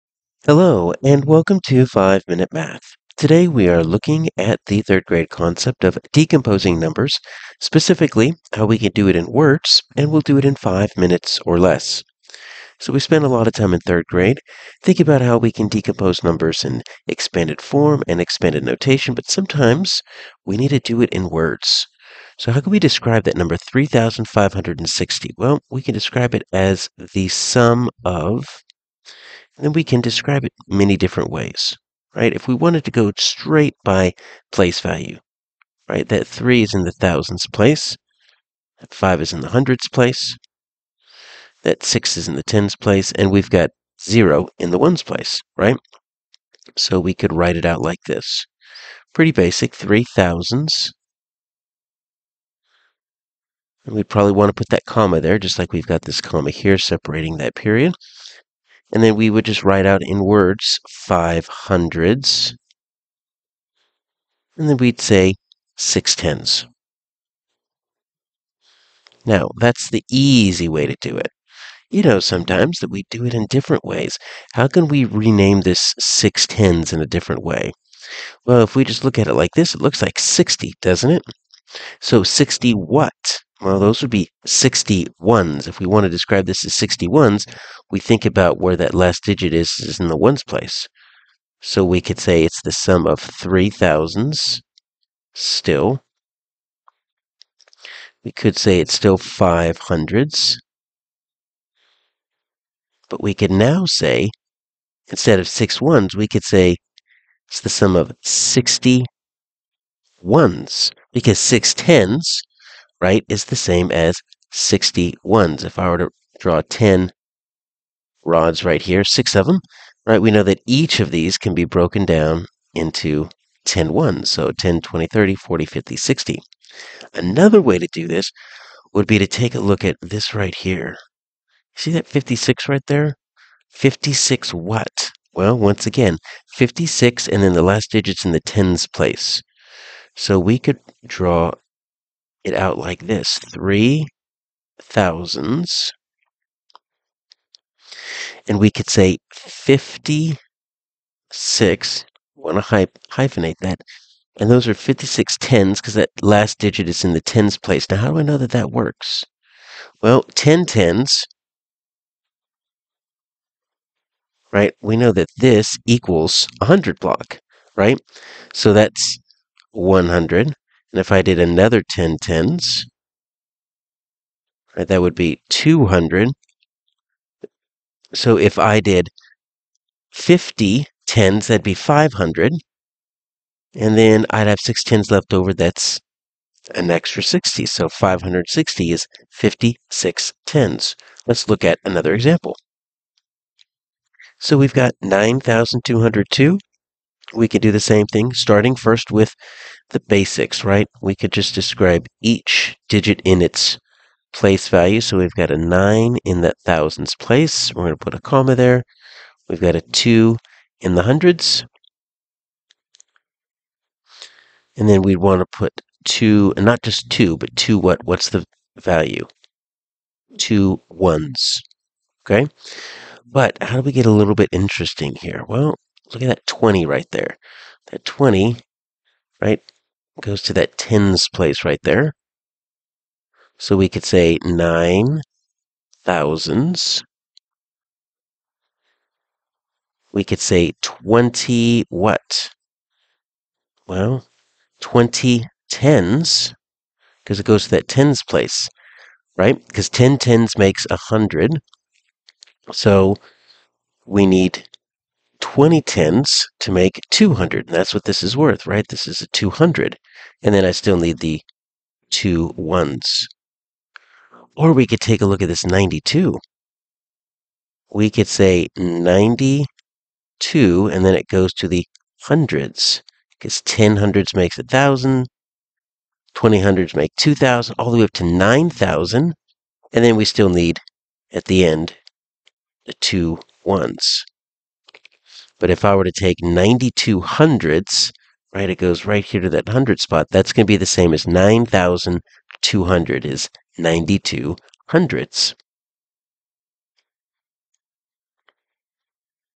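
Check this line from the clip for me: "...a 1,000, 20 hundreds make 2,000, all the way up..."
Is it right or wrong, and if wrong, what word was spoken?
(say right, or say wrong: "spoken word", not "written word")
right.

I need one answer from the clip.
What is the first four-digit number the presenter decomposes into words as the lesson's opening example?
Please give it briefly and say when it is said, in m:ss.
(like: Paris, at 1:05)
3,560, at 0:23.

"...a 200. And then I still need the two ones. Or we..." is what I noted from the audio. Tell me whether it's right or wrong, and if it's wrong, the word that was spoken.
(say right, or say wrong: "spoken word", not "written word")
right.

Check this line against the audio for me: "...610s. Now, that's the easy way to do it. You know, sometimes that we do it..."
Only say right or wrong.
right.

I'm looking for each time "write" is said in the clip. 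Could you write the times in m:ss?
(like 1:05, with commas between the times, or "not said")
0:47, 0:59.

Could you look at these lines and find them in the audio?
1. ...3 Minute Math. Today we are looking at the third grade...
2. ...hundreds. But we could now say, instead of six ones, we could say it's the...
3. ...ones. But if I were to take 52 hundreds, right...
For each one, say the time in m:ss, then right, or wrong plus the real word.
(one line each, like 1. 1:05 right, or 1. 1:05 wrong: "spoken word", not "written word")
1. 0:01 wrong: "5", not "3"
2. 1:39 right
3. 4:43 wrong: "92", not "52".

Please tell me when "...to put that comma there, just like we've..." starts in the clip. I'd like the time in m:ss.
0:54.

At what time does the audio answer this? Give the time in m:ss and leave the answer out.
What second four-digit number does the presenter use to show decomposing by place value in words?
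3:15.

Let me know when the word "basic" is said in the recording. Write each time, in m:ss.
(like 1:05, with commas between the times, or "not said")
0:49, 3:19.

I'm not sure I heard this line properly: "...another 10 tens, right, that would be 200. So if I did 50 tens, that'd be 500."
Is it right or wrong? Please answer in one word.
right.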